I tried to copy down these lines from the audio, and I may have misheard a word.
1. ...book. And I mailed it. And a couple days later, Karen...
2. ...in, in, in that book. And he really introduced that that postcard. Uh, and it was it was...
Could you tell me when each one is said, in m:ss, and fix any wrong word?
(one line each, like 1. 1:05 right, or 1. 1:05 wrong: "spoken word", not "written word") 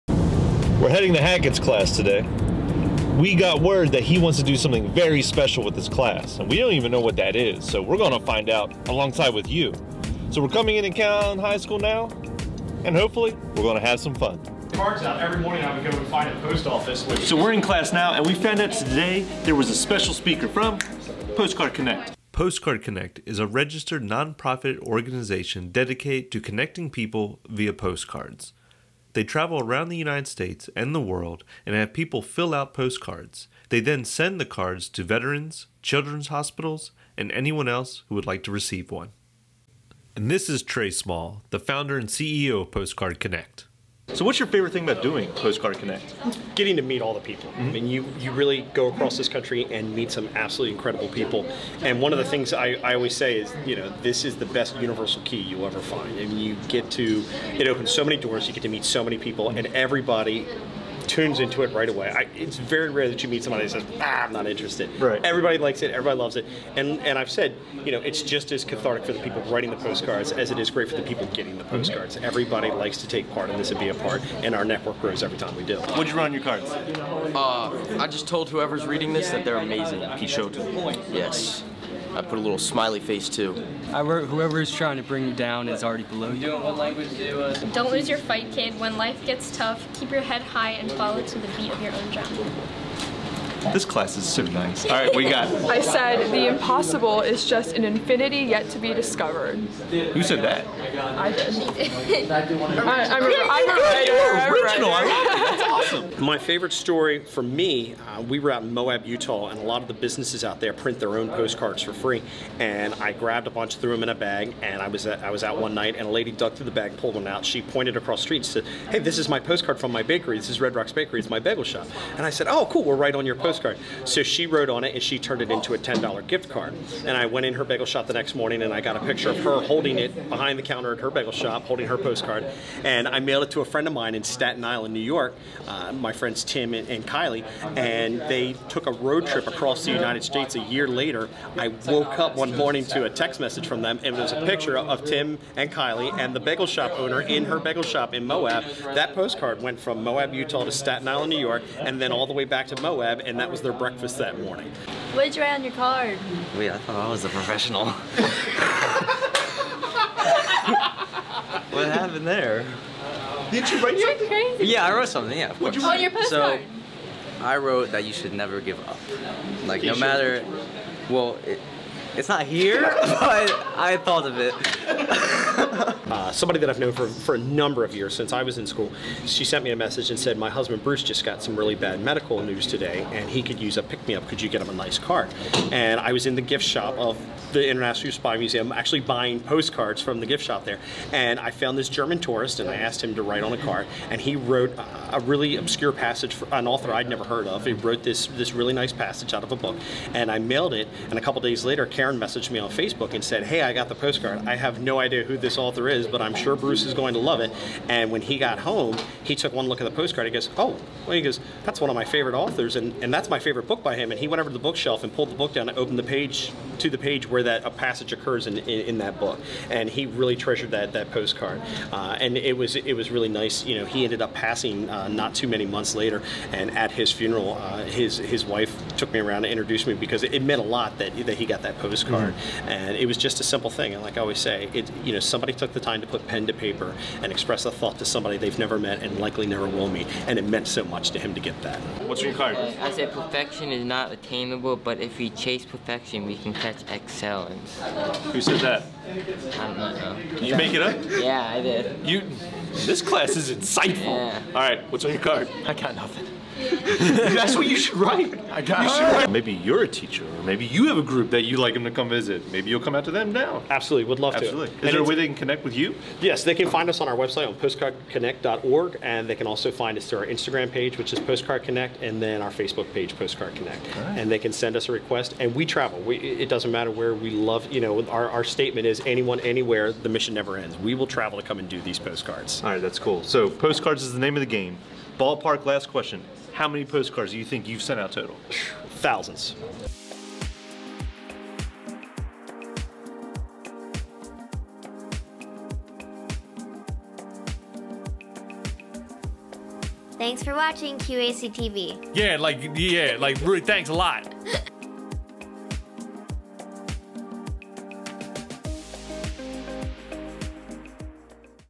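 1. 3:19 right
2. 3:38 wrong: "treasured", not "introduced".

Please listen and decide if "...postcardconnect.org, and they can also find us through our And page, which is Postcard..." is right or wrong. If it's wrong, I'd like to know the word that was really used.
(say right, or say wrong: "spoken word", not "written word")
wrong: "Instagram", not "And".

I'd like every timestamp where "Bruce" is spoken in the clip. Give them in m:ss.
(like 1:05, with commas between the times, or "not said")
3:00, 3:26.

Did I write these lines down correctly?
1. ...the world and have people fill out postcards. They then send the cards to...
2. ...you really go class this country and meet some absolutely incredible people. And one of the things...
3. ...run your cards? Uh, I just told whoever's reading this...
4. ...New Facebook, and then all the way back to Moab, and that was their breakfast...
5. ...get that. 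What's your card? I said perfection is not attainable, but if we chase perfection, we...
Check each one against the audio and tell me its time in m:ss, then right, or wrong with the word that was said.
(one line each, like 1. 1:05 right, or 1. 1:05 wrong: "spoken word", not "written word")
1. 0:30 right
2. 0:48 wrong: "across", not "class"
3. 1:16 right
4. 2:31 wrong: "York", not "Facebook"
5. 4:01 right.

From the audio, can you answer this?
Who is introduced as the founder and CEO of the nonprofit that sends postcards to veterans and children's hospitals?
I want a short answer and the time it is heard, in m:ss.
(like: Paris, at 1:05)
Trey Small, at 0:40.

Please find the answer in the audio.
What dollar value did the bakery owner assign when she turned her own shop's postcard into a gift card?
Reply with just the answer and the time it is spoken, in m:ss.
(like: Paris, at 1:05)
$10, at 2:05.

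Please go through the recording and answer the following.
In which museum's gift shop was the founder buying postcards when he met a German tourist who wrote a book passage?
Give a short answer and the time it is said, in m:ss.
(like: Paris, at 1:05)
International Spy Museum, at 3:07.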